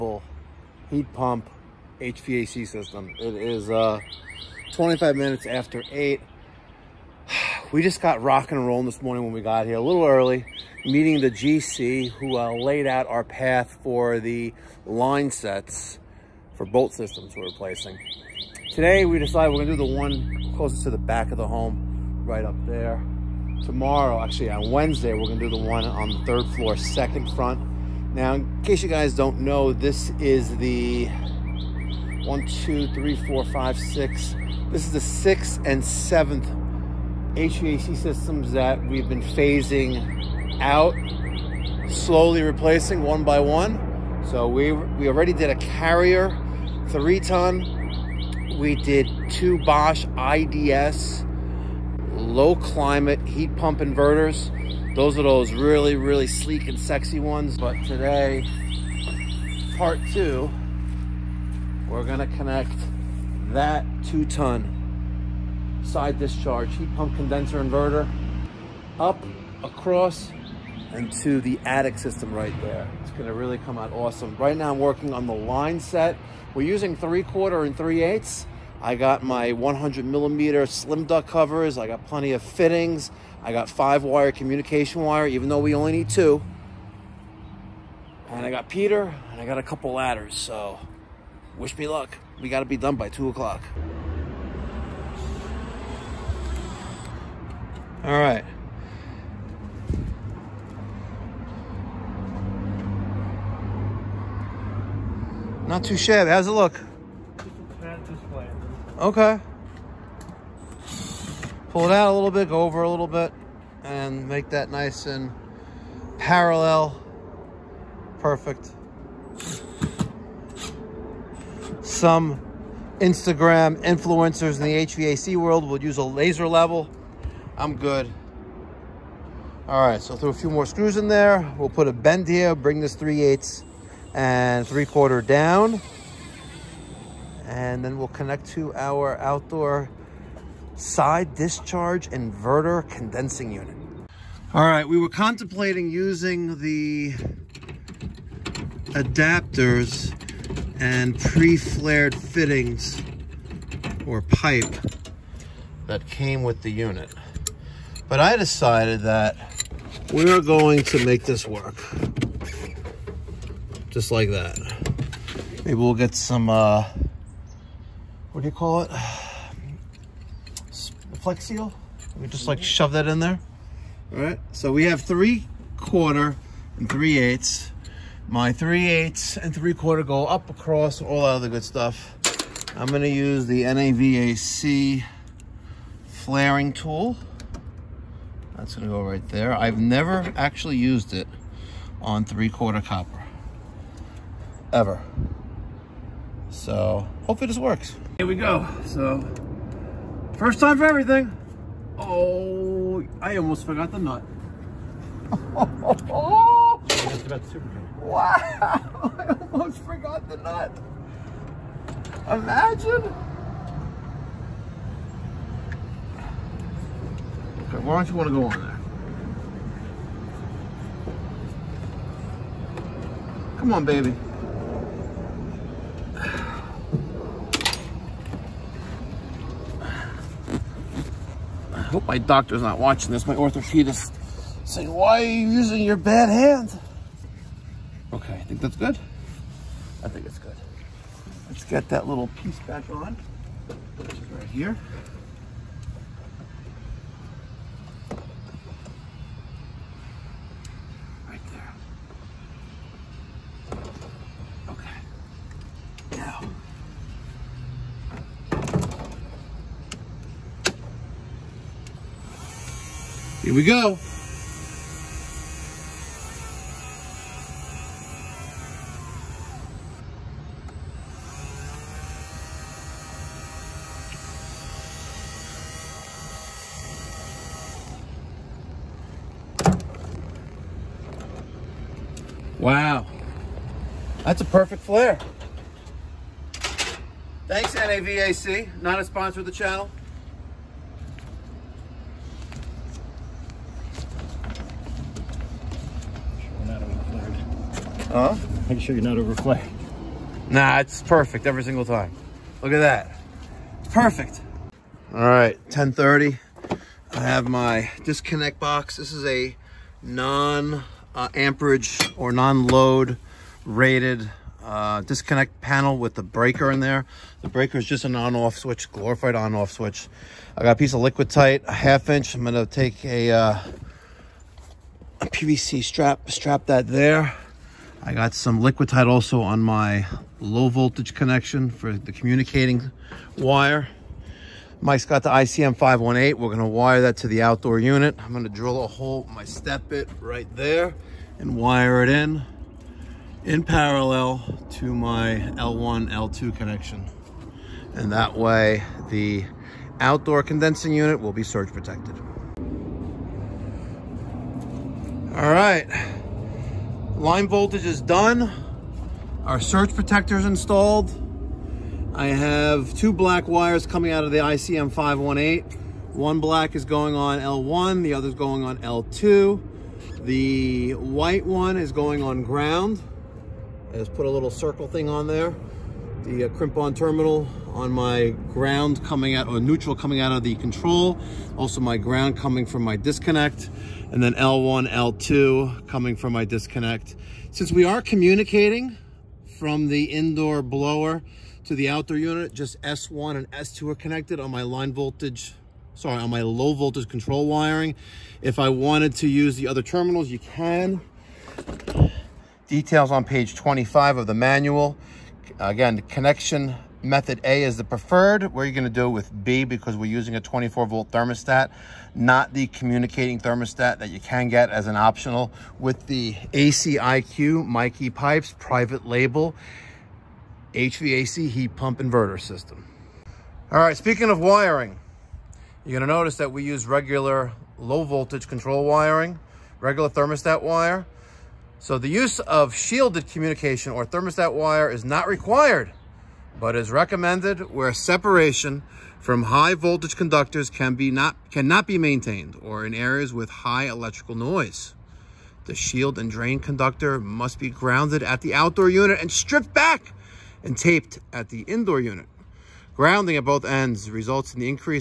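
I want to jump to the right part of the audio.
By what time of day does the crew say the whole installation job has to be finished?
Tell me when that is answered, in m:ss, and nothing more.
1:33.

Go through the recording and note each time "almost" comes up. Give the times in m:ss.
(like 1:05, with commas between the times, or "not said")
3:23, 3:29.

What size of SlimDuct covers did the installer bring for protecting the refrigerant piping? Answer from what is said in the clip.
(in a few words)
100 millimeter.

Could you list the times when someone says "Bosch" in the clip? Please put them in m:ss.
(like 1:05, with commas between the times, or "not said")
0:49.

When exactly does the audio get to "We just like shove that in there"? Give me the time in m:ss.
2:52.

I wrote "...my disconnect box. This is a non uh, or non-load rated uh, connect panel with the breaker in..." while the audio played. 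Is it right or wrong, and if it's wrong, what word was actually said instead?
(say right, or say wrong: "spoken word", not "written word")
wrong: "disconnect", not "connect".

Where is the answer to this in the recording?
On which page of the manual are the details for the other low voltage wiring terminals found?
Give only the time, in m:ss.
6:43.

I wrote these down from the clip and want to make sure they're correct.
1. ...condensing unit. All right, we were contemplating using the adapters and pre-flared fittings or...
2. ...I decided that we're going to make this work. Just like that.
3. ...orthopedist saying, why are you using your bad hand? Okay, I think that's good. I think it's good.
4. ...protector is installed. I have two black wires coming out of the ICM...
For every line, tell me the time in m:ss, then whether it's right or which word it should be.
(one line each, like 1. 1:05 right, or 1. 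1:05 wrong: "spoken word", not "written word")
1. 2:22 right
2. 2:38 right
3. 3:53 right
4. 5:59 right.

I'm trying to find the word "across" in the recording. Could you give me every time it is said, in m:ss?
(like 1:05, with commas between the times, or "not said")
1:09, 3:00.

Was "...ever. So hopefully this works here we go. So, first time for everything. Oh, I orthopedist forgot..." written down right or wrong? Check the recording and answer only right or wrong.
wrong.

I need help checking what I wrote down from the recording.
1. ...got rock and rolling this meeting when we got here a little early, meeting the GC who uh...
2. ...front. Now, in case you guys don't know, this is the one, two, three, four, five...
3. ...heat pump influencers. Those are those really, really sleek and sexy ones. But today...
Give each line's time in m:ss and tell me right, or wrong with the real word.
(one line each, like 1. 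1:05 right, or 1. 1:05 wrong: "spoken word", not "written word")
1. 0:08 wrong: "morning", not "meeting"
2. 0:27 right
3. 0:53 wrong: "inverters", not "influencers".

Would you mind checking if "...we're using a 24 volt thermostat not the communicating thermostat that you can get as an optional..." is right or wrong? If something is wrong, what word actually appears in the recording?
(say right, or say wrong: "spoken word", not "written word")
right.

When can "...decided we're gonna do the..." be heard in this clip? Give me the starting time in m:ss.
0:19.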